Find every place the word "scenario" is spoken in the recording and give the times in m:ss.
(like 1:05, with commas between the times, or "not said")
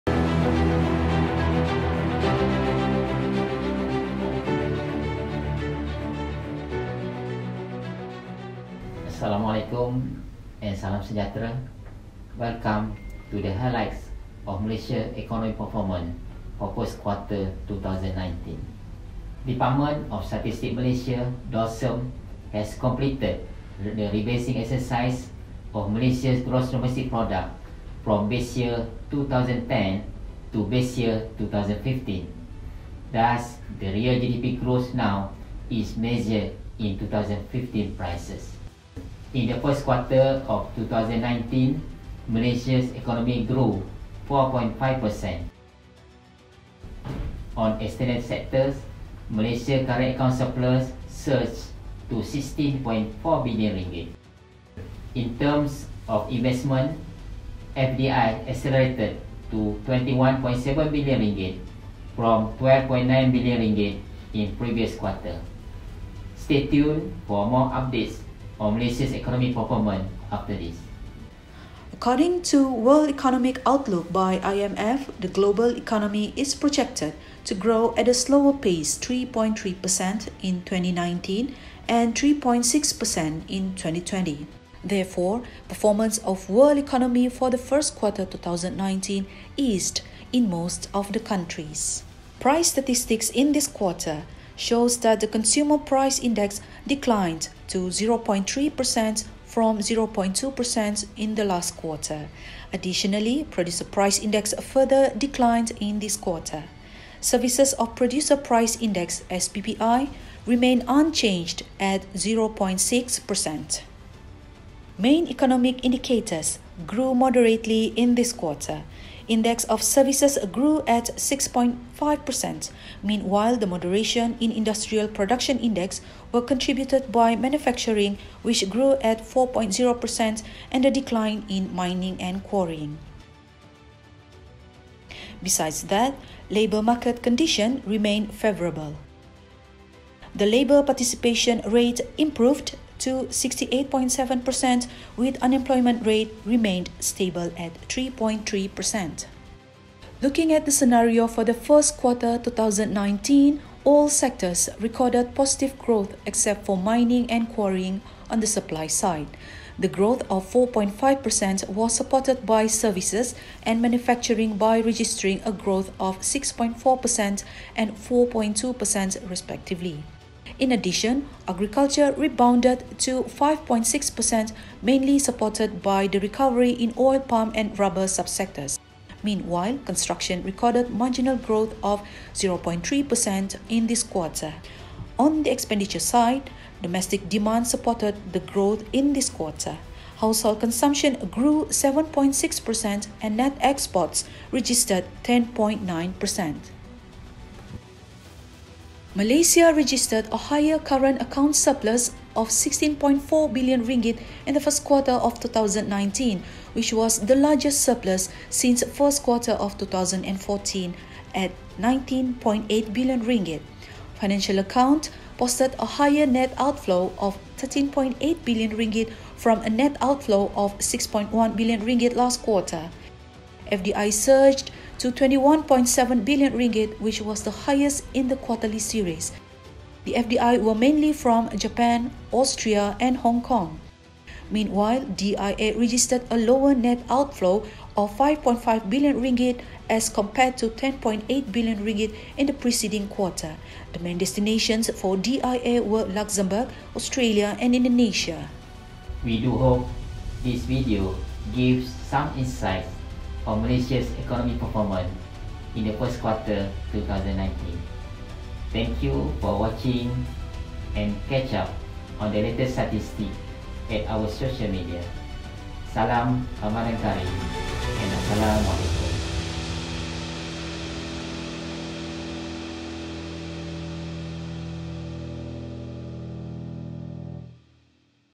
2:30.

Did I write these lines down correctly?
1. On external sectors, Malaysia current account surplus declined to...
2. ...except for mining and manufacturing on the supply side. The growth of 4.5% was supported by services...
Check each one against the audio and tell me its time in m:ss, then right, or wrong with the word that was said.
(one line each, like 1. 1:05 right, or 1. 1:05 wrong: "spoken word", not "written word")
1. 0:47 wrong: "surged", not "declined"
2. 2:36 wrong: "quarrying", not "manufacturing".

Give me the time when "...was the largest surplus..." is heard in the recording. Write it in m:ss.
3:26.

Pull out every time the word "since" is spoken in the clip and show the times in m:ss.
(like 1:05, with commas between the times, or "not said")
3:28.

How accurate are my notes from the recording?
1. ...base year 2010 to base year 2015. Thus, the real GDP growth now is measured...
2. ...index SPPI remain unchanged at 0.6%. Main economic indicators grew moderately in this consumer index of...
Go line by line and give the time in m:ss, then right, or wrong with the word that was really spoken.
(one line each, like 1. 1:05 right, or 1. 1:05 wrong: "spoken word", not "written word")
1. 0:28 right
2. 1:48 wrong: "quarter", not "consumer".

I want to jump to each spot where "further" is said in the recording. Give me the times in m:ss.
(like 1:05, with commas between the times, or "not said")
1:44.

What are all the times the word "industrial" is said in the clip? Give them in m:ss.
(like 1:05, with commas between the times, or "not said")
2:04.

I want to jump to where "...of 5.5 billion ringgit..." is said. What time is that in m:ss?
3:57.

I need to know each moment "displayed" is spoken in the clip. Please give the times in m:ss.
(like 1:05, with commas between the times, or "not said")
not said.